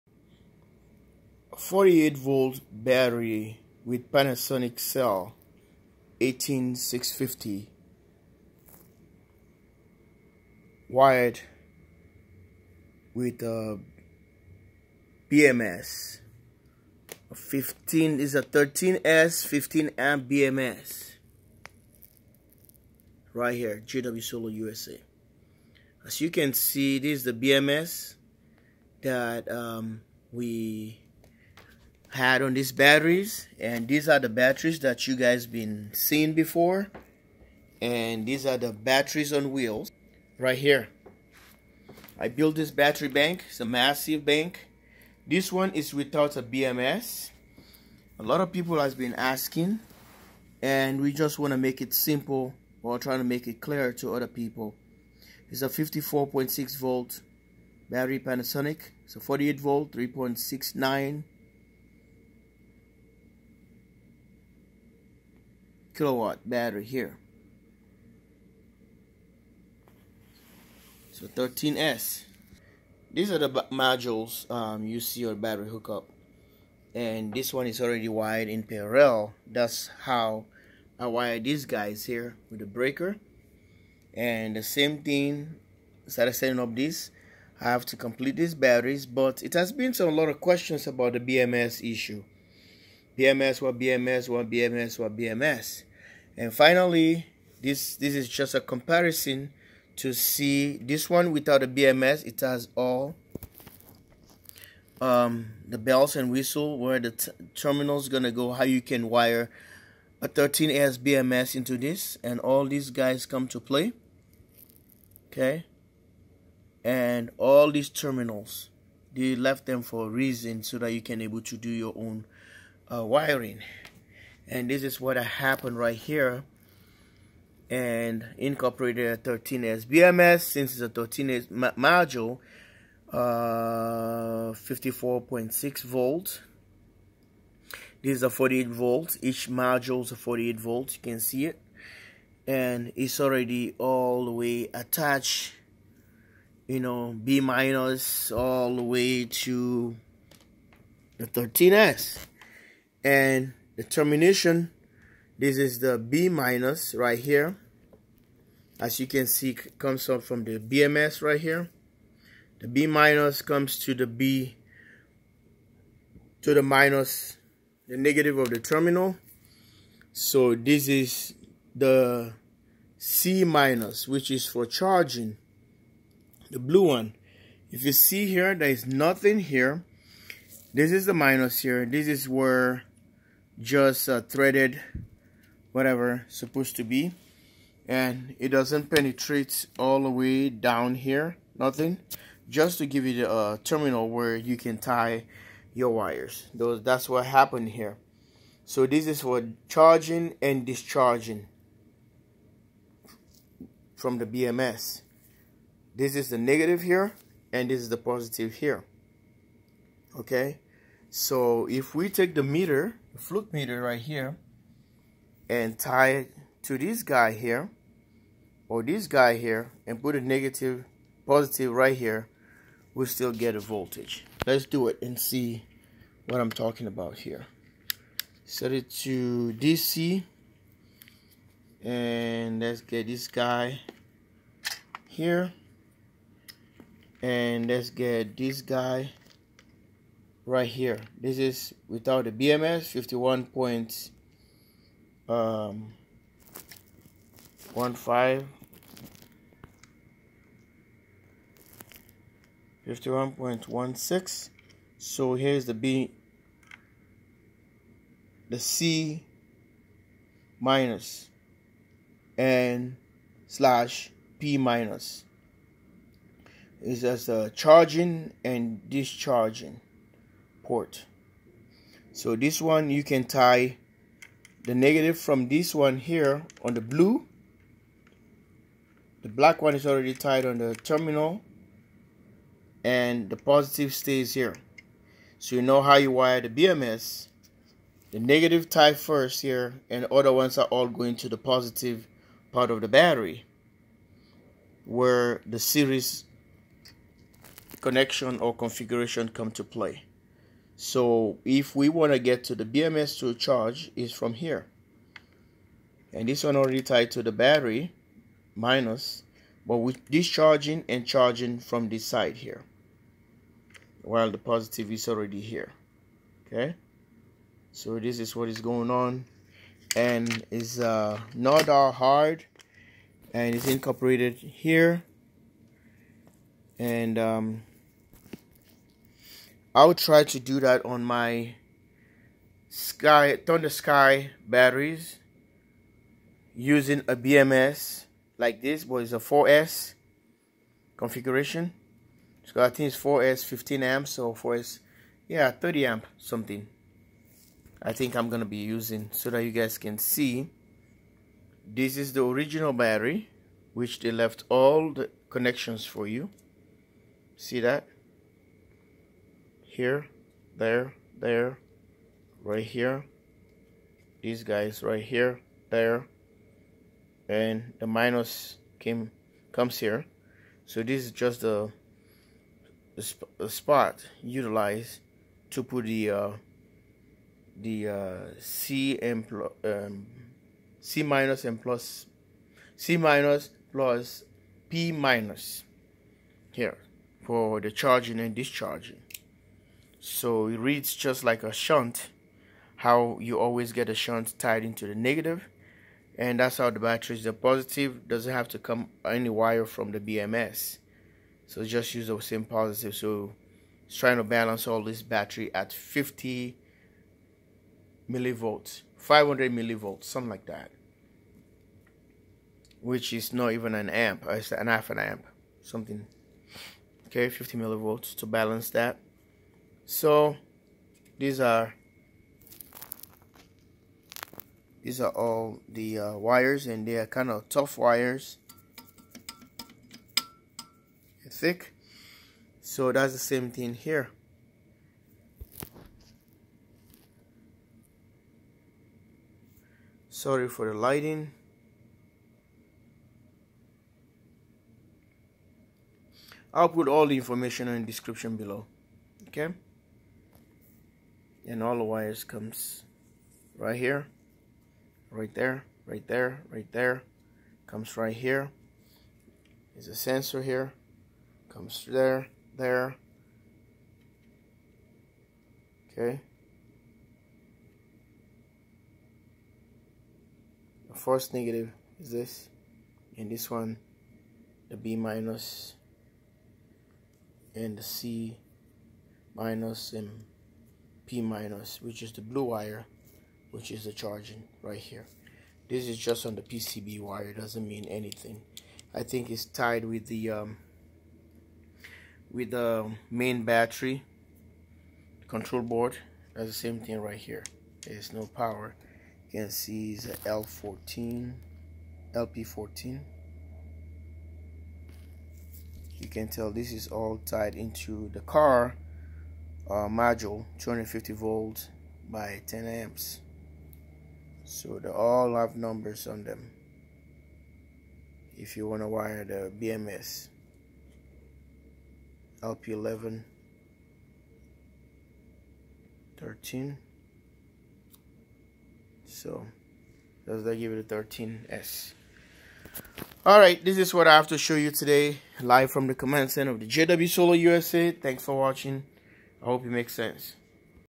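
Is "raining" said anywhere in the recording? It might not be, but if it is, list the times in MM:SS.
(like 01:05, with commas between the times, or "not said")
not said.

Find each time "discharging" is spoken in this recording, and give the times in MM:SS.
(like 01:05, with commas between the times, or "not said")
03:20, 04:28, 05:10, 06:28.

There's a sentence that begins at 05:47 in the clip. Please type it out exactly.
I think I'm gonna be using so that you guys can see.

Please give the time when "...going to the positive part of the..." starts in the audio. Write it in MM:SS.
04:50.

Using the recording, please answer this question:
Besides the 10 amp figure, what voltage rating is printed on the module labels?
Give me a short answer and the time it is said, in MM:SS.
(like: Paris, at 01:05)
250 volts, at 08:30.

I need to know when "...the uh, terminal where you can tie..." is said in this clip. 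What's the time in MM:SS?
03:13.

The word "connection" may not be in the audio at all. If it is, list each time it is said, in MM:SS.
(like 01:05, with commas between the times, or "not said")
04:57, 05:55.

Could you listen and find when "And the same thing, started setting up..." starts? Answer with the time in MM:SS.
01:24.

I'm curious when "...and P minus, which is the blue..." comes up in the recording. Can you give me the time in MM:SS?
07:59.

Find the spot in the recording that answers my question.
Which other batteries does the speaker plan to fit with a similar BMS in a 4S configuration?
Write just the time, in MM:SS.
05:33.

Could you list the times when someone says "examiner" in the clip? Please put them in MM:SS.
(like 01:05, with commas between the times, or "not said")
not said.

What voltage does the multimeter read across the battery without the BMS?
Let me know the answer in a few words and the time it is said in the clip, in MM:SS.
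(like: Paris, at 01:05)
51.16, at 04:12.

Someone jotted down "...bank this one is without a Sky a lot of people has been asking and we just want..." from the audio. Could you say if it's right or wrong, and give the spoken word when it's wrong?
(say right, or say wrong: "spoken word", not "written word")
wrong: "BMS", not "Sky".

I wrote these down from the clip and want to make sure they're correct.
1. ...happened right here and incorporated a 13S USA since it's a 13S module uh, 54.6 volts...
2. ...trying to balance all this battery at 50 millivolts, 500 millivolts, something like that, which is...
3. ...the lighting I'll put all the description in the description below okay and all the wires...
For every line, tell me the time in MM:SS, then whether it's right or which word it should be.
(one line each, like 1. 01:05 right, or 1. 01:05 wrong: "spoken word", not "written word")
1. 02:05 wrong: "BMS", not "USA"
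2. 06:43 right
3. 07:20 wrong: "information", not "description".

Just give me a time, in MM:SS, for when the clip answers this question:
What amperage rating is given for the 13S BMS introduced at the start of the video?
00:19.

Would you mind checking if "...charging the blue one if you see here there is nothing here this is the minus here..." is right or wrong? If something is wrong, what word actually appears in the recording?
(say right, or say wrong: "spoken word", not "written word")
right.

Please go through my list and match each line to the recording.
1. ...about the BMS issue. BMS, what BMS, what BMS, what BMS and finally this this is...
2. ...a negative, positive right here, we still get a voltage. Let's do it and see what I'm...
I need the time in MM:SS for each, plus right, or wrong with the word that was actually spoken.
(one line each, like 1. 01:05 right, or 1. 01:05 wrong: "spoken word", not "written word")
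1. 01:30 right
2. 03:40 right.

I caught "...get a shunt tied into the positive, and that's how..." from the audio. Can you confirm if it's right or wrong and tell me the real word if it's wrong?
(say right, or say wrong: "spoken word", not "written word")
wrong: "negative", not "positive".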